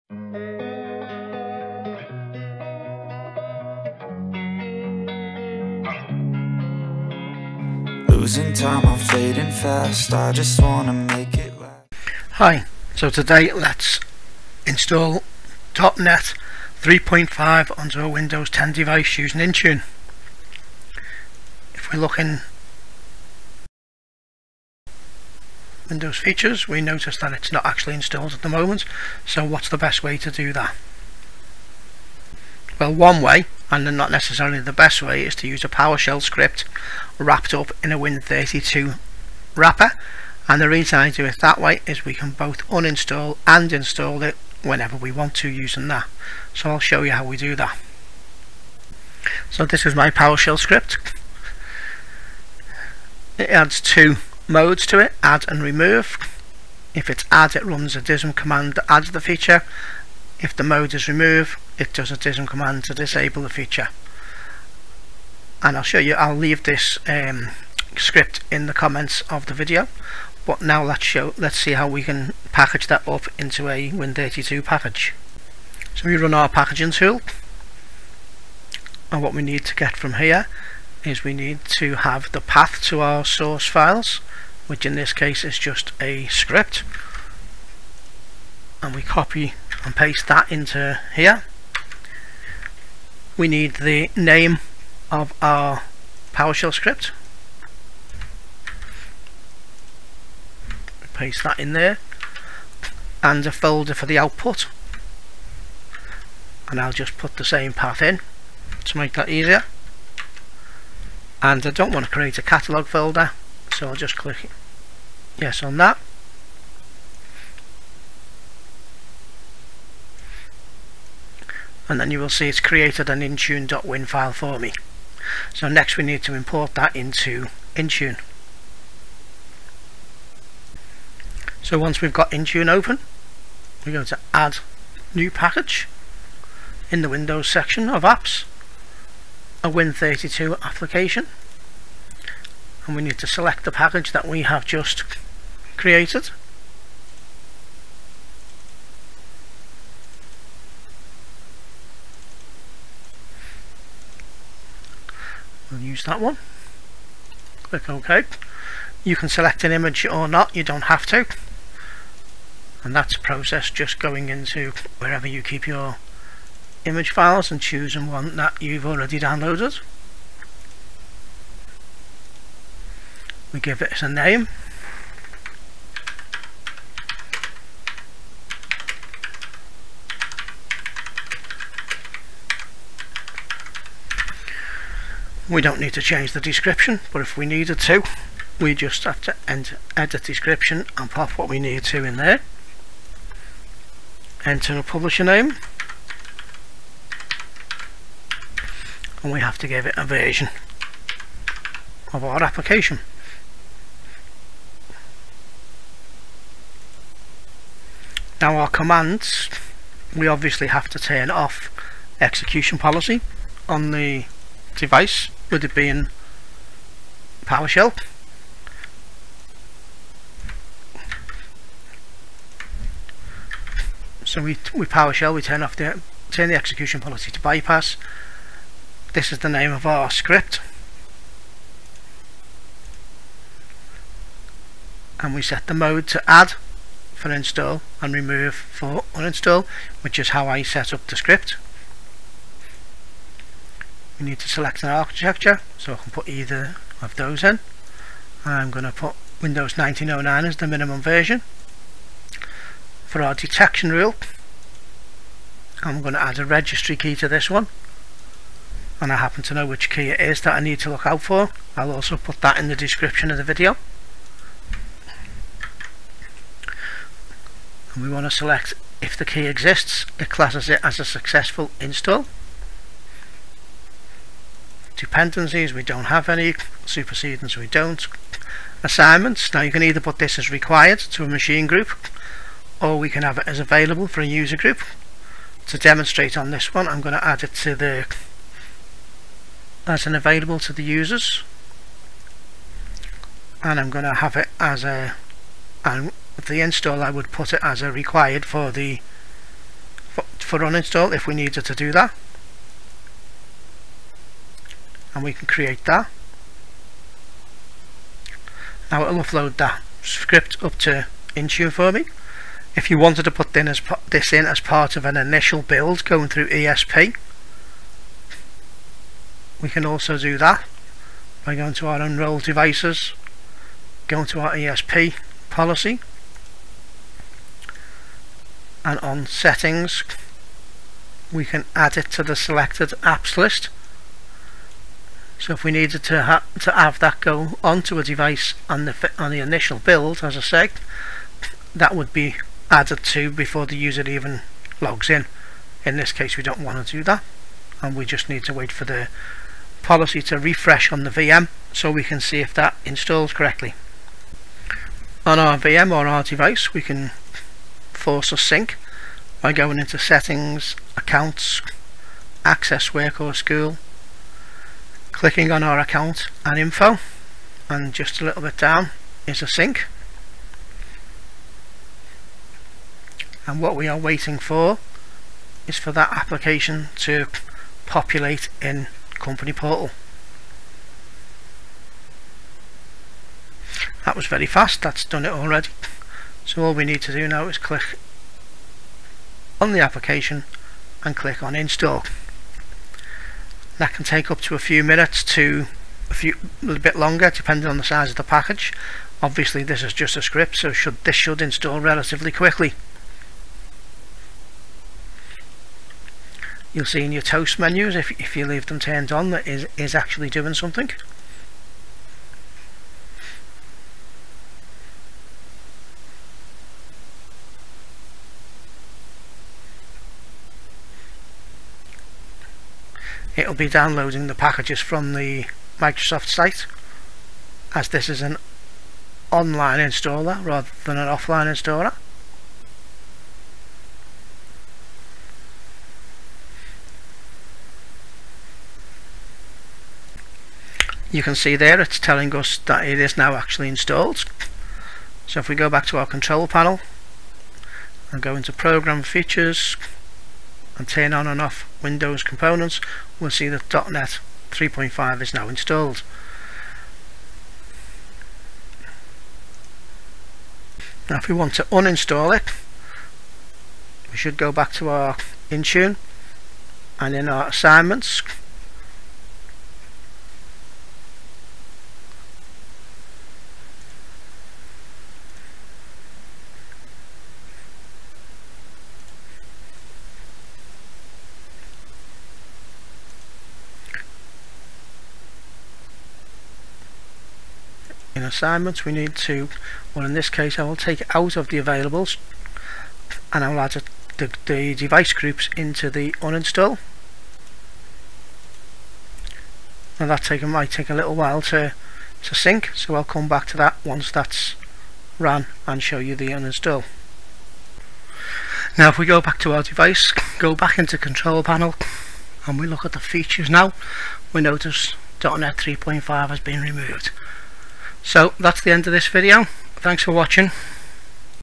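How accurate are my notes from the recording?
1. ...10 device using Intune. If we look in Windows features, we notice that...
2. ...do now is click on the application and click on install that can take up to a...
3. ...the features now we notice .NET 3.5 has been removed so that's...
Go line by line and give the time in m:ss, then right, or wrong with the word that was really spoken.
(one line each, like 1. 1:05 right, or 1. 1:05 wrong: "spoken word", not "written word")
1. 0:18 right
2. 6:27 right
3. 8:32 right.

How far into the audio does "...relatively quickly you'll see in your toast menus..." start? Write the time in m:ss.
6:41.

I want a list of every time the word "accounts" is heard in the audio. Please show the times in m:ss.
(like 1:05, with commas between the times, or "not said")
6:00, 6:05.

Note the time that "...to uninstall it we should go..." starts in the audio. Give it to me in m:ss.
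7:41.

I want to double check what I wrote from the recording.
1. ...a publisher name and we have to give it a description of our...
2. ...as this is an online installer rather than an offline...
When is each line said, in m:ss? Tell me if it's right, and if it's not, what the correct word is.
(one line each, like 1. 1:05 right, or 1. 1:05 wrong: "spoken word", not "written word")
1. 3:14 wrong: "version", not "description"
2. 7:07 right.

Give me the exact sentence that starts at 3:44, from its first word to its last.
So we, we PowerShell, we turn off the turn the execution policy to bypass.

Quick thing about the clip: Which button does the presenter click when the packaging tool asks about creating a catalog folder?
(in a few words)
Yes.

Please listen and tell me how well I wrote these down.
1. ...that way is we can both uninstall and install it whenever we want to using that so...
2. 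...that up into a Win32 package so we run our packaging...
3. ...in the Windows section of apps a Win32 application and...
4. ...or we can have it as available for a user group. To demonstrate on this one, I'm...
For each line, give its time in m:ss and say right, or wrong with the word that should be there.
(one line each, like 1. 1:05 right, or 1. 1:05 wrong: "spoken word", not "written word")
1. 0:41 right
2. 1:12 right
3. 2:16 right
4. 4:42 right.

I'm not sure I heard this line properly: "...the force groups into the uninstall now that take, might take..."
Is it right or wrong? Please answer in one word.
wrong.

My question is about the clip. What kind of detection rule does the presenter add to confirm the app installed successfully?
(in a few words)
Registry key.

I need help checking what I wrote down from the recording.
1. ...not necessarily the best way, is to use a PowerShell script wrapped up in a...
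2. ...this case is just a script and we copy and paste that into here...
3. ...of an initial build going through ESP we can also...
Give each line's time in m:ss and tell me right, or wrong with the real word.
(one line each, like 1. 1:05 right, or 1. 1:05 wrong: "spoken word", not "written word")
1. 0:33 right
2. 1:24 right
3. 5:14 right.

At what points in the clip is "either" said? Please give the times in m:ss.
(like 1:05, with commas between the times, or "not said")
4:06, 4:39.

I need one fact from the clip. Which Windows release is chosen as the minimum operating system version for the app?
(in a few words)
Windows 1909.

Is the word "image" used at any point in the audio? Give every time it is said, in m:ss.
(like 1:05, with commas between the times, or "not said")
2:39, 2:46.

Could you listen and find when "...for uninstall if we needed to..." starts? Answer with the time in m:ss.
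5:00.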